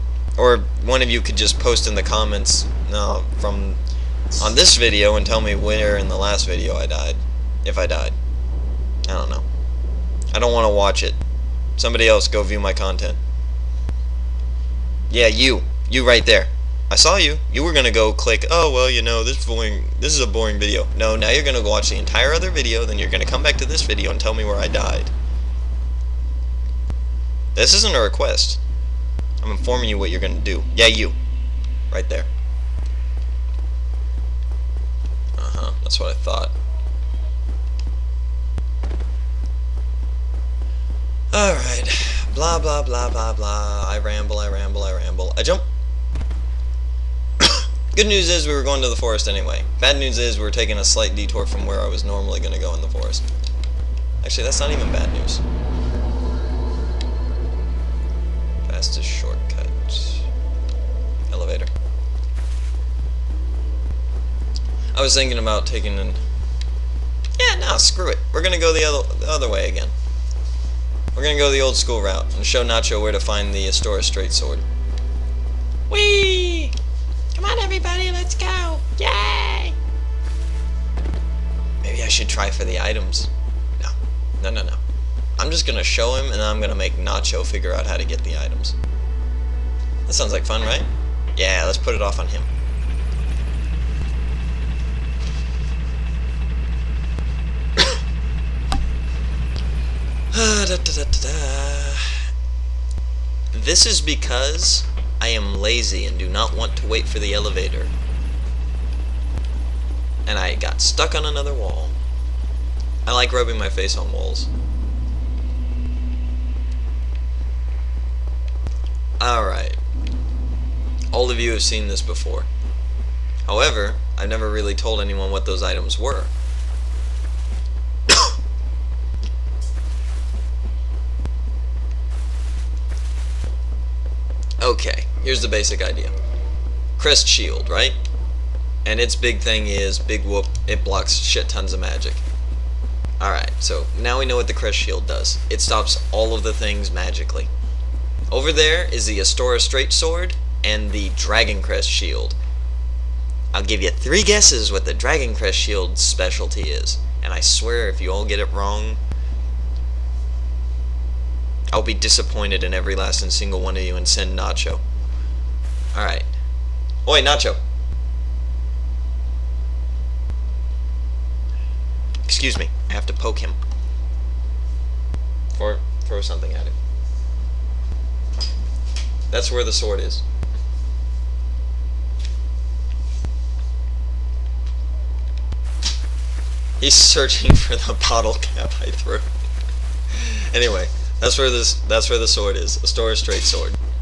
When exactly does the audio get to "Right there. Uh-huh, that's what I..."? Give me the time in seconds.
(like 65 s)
31 s.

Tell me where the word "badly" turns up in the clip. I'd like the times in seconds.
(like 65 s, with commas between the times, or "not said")
not said.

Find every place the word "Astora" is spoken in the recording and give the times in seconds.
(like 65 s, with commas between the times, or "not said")
73 s, 149 s, 192 s.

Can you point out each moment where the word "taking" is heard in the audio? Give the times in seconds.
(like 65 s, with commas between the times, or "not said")
50 s, 65 s.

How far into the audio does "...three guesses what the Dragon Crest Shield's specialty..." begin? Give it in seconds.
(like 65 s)
153 s.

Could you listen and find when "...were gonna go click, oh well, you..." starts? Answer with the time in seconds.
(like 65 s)
17 s.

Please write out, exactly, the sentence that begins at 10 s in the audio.
I don't want to watch it.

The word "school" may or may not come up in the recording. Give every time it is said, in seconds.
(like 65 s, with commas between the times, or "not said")
71 s.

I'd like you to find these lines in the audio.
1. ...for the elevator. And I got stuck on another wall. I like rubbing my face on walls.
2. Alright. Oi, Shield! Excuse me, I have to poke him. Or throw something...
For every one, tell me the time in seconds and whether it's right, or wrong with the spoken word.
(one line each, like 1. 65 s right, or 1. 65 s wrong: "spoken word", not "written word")
1. 107 s right
2. 165 s wrong: "Nacho", not "Shield".